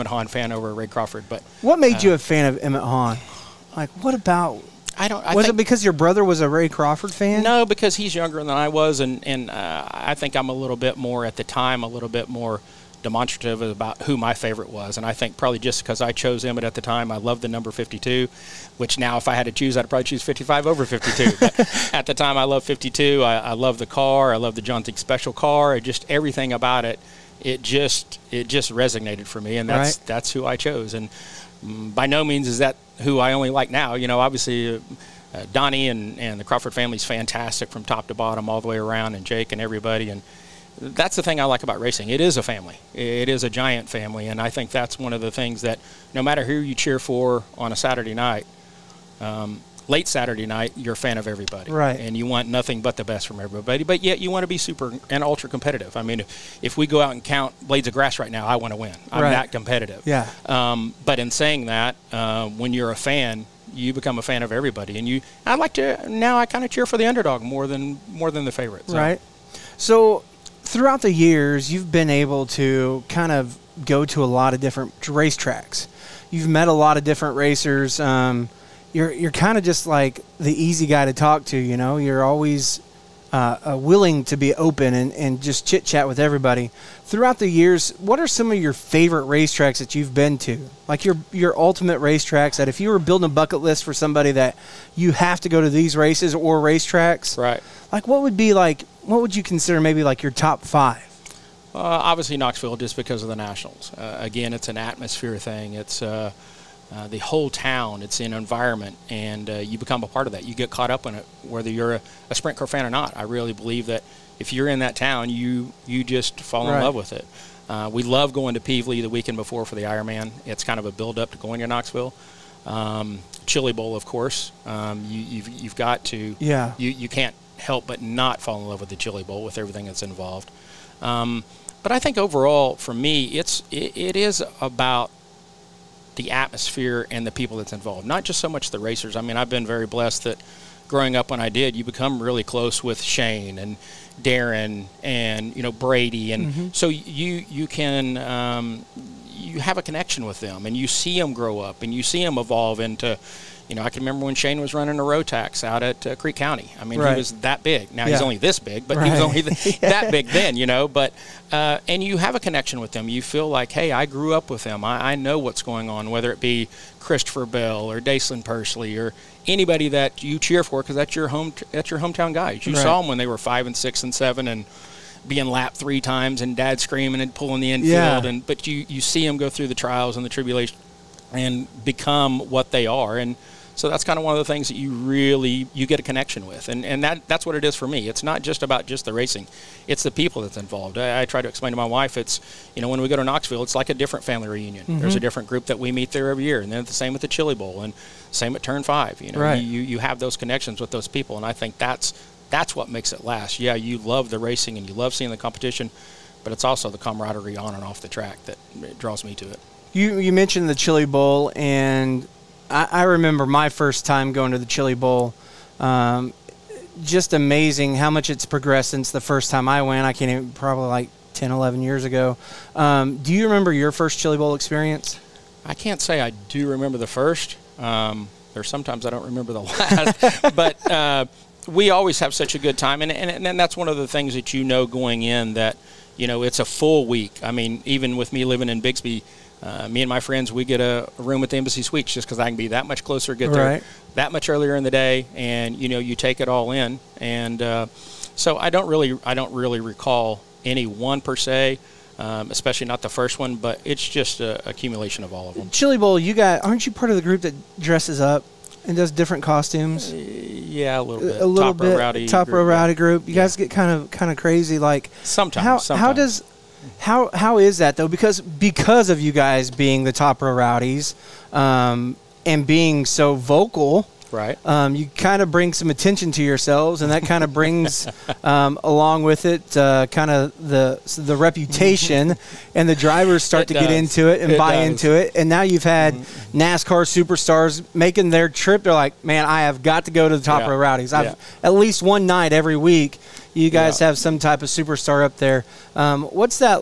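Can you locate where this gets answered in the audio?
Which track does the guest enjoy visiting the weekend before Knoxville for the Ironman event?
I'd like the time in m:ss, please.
1:58.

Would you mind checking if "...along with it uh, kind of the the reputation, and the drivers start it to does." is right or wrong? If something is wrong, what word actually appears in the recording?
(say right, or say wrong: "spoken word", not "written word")
right.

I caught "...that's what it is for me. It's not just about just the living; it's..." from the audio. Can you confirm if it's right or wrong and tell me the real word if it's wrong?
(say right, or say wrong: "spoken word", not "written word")
wrong: "racing", not "living".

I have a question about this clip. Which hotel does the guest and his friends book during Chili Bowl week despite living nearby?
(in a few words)
Embassy Suites.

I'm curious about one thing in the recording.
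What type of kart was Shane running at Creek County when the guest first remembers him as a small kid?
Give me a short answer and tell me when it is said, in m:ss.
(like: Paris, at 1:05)
Rotax, at 2:35.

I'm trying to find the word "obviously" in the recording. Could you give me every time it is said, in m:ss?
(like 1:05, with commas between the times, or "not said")
0:34, 1:41.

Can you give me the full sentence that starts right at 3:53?
And, and, and that's one of the things that you know going in that, you know, it's a full week.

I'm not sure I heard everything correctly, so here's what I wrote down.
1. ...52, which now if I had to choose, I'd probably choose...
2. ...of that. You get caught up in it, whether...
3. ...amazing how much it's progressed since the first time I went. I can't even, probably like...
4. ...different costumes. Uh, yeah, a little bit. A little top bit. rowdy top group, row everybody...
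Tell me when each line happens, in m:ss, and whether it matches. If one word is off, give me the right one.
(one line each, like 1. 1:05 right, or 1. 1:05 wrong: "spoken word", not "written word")
1. 0:17 right
2. 1:50 right
3. 3:37 right
4. 4:19 wrong: "rowdy", not "everybody".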